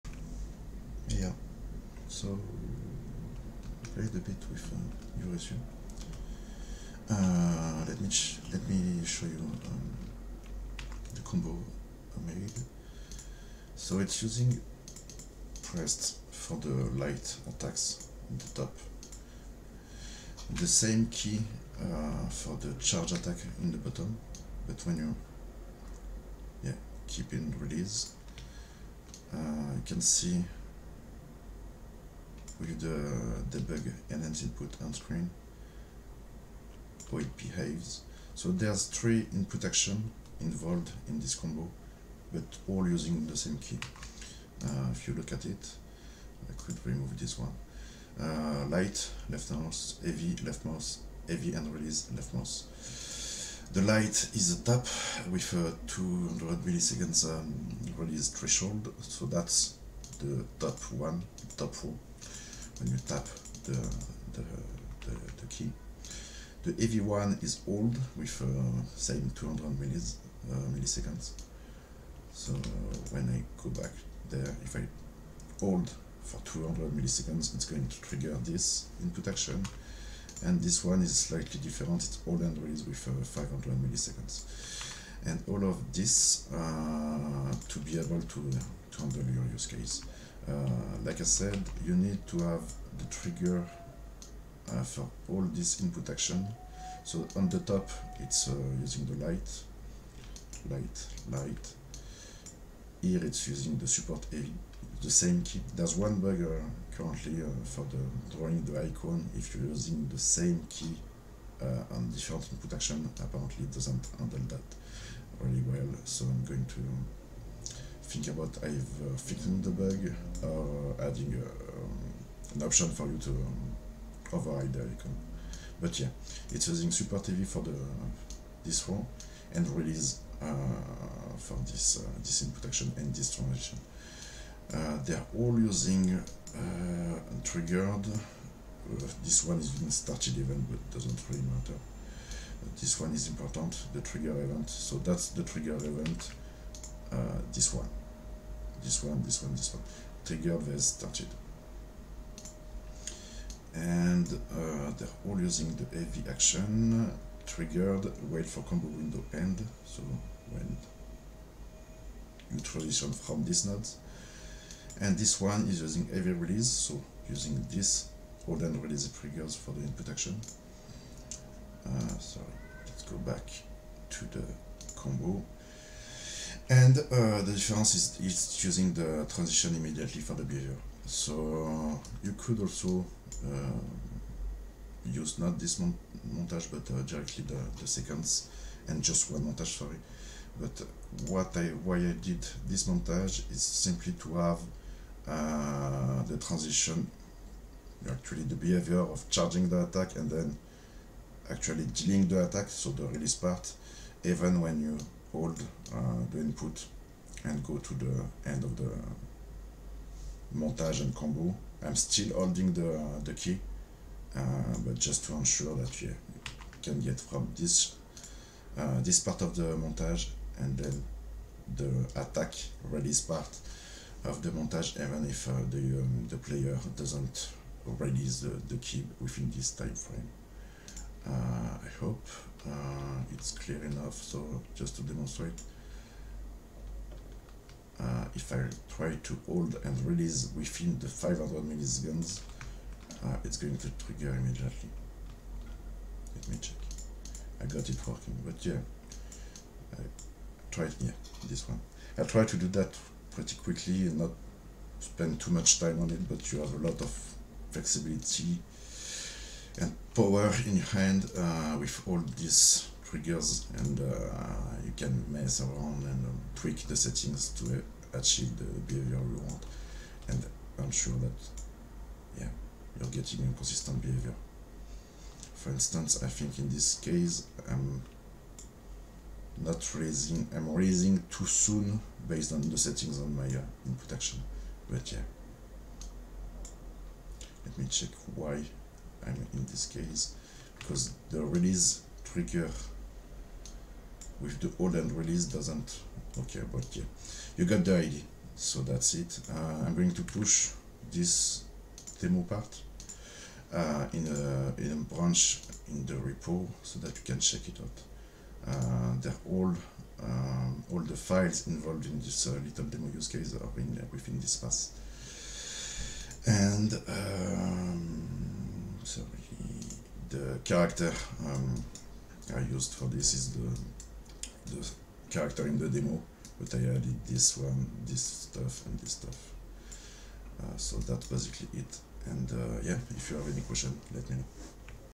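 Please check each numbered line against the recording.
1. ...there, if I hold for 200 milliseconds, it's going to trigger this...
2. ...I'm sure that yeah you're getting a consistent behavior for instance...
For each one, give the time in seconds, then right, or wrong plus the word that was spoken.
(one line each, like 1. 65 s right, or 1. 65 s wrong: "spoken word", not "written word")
1. 74 s right
2. 270 s right.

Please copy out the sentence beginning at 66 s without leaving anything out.
The heavy one is old with uh, same 200 millis, uh, milliseconds.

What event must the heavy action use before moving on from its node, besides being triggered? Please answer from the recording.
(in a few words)
wait for combo window end.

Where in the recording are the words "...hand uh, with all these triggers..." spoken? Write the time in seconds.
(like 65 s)
260 s.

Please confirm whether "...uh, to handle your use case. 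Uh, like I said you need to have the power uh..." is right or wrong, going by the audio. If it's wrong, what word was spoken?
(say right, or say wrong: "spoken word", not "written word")
wrong: "trigger", not "power".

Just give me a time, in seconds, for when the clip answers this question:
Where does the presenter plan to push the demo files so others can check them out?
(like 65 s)
304 s.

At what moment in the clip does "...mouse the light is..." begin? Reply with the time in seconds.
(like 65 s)
52 s.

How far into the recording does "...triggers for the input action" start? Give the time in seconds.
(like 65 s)
169 s.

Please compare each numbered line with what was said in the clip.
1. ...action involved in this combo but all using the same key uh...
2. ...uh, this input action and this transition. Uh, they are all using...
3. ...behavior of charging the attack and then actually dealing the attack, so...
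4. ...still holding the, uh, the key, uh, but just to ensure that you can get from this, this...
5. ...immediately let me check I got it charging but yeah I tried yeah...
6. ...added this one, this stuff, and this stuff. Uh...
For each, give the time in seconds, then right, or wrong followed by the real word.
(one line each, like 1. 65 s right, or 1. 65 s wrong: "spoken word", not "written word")
1. 39 s right
2. 132 s right
3. 198 s right
4. 211 s right
5. 244 s wrong: "working", not "charging"
6. 326 s right.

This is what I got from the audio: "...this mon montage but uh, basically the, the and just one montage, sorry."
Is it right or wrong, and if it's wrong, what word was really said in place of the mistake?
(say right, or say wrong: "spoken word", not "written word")
wrong: "directly", not "basically".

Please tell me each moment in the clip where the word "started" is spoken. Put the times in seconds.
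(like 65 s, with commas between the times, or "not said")
139 s, 150 s.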